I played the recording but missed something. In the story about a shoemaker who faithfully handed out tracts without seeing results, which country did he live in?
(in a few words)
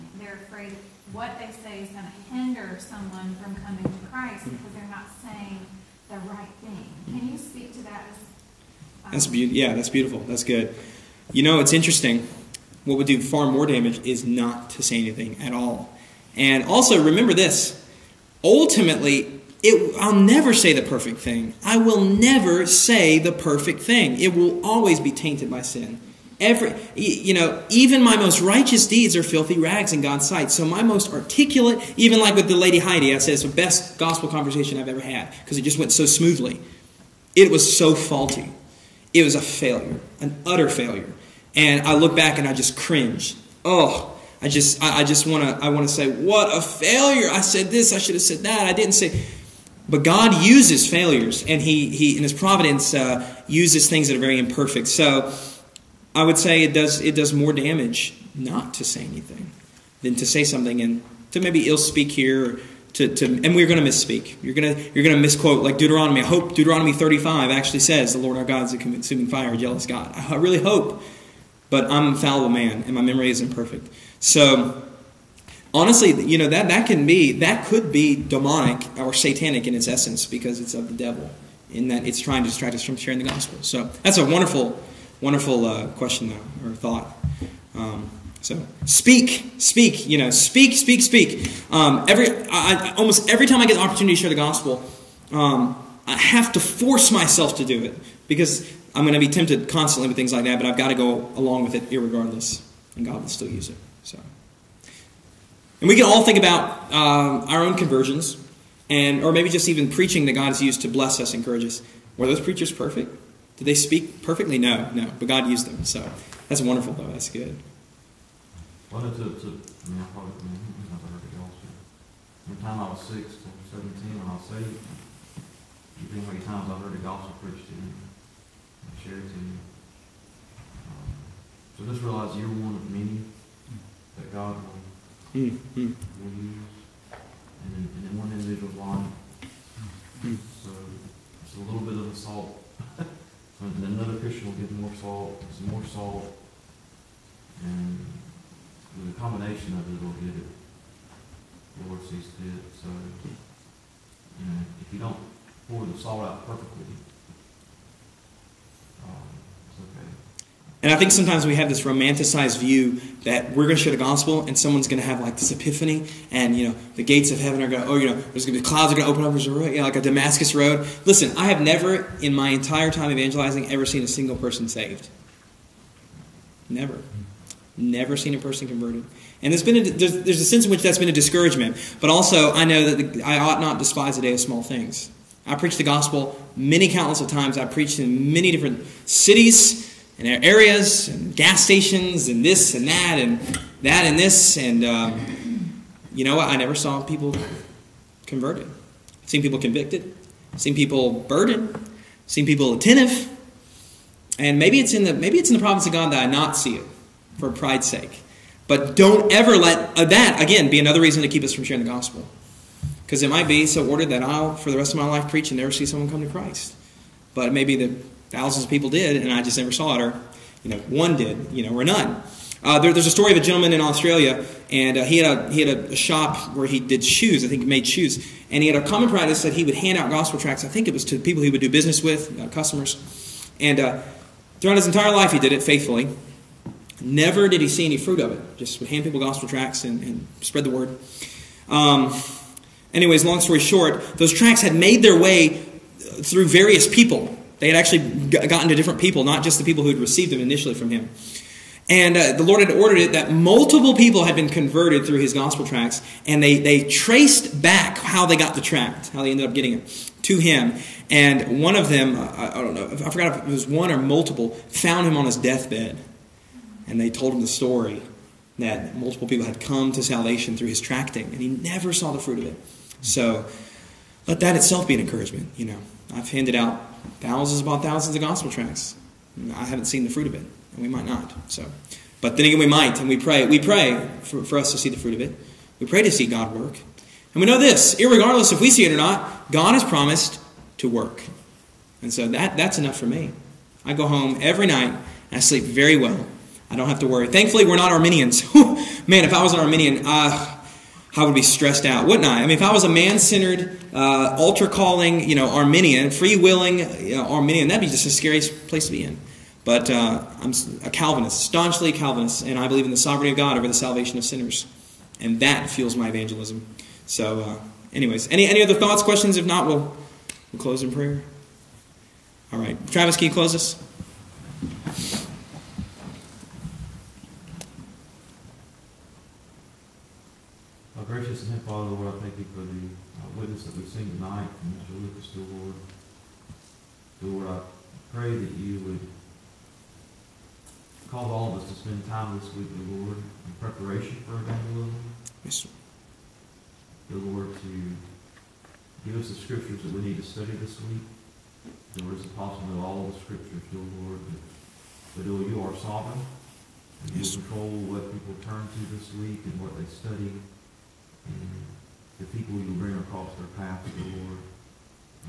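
Australia.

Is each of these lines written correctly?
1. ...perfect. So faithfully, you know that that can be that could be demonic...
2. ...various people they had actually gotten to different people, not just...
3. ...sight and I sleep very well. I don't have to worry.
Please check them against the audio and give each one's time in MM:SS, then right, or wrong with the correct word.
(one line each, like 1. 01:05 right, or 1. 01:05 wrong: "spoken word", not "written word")
1. 01:13 wrong: "honestly", not "faithfully"
2. 04:06 right
3. 04:54 wrong: "night", not "sight".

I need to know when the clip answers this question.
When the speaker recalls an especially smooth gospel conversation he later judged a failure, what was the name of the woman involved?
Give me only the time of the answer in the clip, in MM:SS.
00:32.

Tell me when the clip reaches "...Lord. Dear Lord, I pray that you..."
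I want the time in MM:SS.
05:35.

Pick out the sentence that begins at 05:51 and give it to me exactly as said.
Dear Lord, it's possible that all the scriptures, dear Lord, but, but Lord, you are sovereign.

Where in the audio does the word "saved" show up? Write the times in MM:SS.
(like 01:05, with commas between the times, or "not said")
02:04, 02:54.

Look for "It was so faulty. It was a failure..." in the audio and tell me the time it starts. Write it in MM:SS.
00:37.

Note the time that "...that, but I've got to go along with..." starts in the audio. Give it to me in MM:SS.
01:40.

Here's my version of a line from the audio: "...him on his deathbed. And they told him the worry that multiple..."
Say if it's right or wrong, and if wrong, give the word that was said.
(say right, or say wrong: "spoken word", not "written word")
wrong: "story", not "worry".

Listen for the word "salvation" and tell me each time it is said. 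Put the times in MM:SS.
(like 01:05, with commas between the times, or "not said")
04:30, 05:13.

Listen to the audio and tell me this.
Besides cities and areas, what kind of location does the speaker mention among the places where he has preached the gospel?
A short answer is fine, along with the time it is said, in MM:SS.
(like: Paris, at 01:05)
gas stations, at 03:11.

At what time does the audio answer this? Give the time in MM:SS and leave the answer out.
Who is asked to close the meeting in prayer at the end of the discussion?
05:22.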